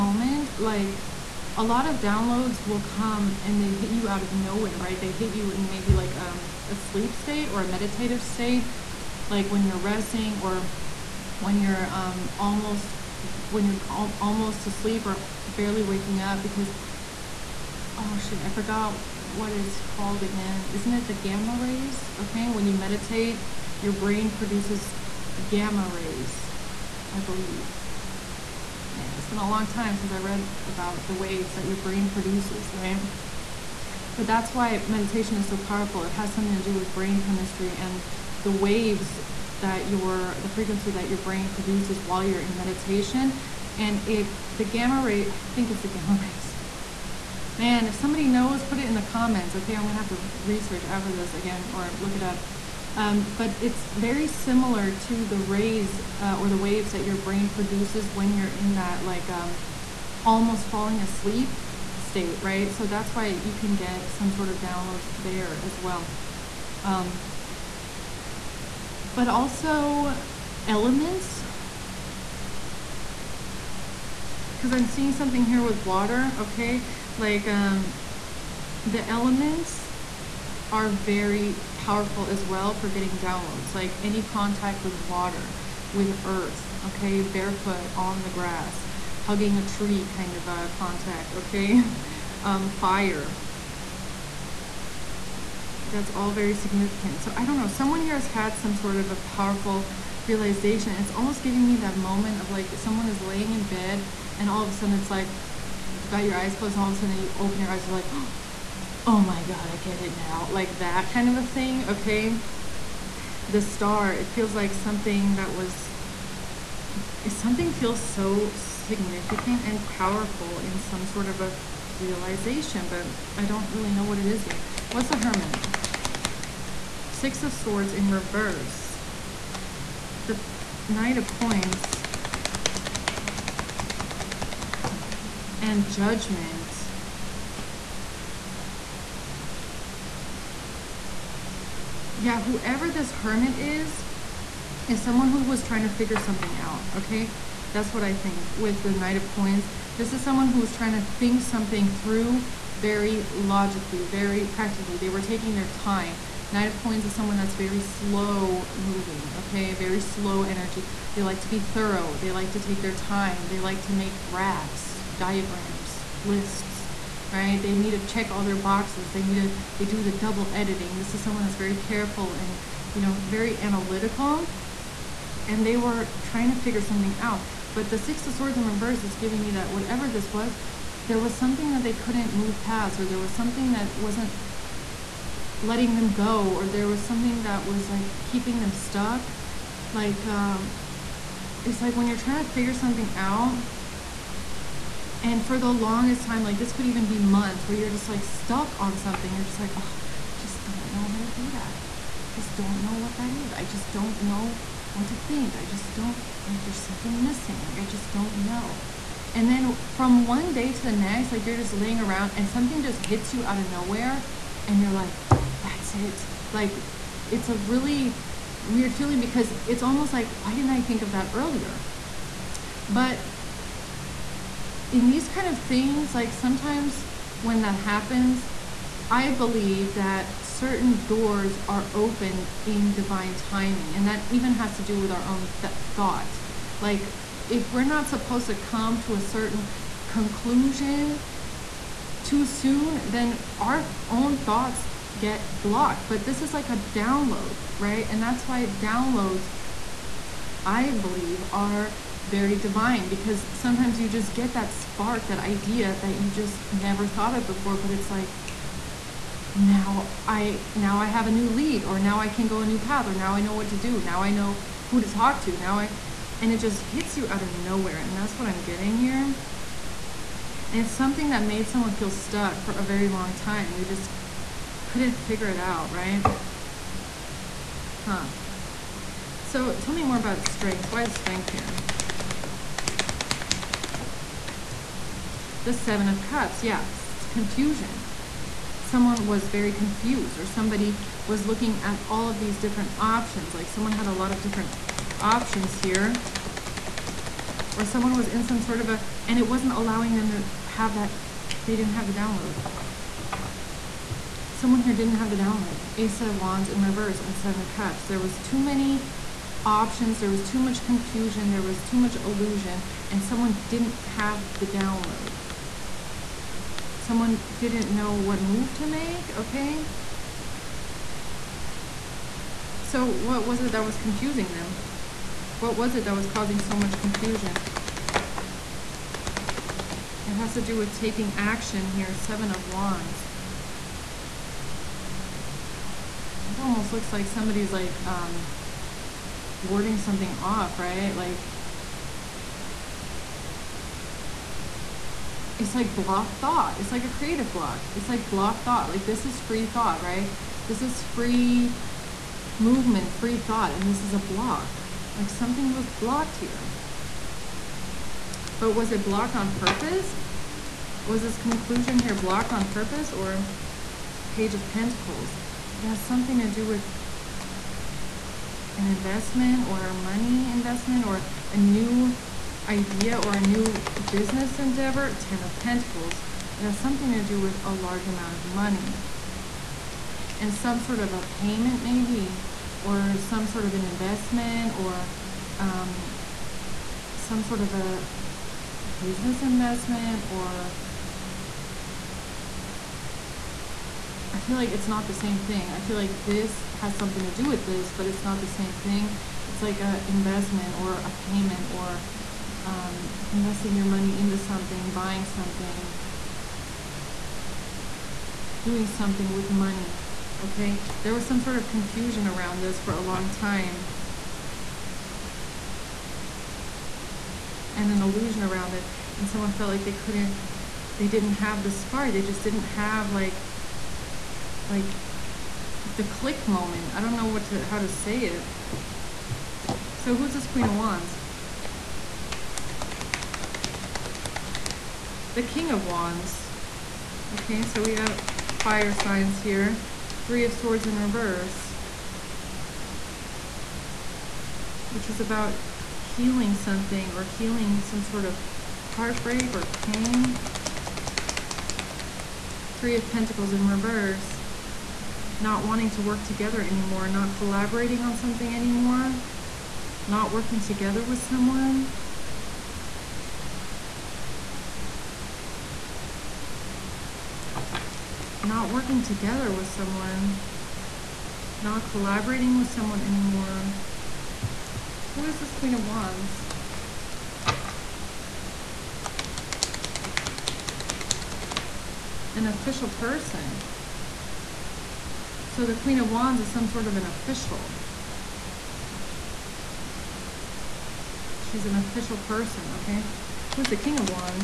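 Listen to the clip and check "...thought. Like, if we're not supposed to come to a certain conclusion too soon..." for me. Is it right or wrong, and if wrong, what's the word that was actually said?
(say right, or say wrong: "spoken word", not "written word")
right.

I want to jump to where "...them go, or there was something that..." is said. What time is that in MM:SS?
03:05.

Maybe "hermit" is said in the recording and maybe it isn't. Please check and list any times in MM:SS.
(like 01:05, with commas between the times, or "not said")
02:05, 02:23.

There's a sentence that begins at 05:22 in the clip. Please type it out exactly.
So what was it that was confusing them?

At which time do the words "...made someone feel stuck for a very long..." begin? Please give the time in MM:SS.
04:31.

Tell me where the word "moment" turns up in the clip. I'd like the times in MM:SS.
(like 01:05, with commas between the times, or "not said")
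01:41, 07:06.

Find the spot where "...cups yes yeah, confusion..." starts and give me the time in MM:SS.
04:46.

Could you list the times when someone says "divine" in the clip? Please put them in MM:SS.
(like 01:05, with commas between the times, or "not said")
03:52, 04:12.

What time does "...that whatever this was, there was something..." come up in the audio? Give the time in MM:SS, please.
02:59.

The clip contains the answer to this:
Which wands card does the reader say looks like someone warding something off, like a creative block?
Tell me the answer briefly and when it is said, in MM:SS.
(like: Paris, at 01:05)
Seven of Wands, at 05:32.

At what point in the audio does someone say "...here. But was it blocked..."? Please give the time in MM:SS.
05:56.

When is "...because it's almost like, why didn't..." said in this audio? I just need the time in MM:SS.
03:39.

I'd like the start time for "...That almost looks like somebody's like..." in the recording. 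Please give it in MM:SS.
05:36.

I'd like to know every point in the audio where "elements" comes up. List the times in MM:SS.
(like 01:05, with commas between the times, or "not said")
01:10, 01:19.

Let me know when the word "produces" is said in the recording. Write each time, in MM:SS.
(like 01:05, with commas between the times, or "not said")
00:24, 00:32, 00:41, 00:57.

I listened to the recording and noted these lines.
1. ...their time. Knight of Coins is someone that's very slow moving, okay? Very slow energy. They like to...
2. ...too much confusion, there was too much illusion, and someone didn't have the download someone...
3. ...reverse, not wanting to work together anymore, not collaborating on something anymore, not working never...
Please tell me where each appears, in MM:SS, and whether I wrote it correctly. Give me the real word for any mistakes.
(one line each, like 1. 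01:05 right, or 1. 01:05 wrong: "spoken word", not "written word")
1. 02:35 right
2. 05:10 right
3. 07:33 wrong: "together", not "never".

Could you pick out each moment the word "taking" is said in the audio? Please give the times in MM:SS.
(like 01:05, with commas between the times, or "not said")
02:35, 05:30.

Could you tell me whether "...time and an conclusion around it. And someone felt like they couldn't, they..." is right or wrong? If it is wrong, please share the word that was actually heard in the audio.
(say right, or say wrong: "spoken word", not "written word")
wrong: "illusion", not "conclusion".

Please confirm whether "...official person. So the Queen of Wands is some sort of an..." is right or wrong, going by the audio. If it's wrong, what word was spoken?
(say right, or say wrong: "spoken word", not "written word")
right.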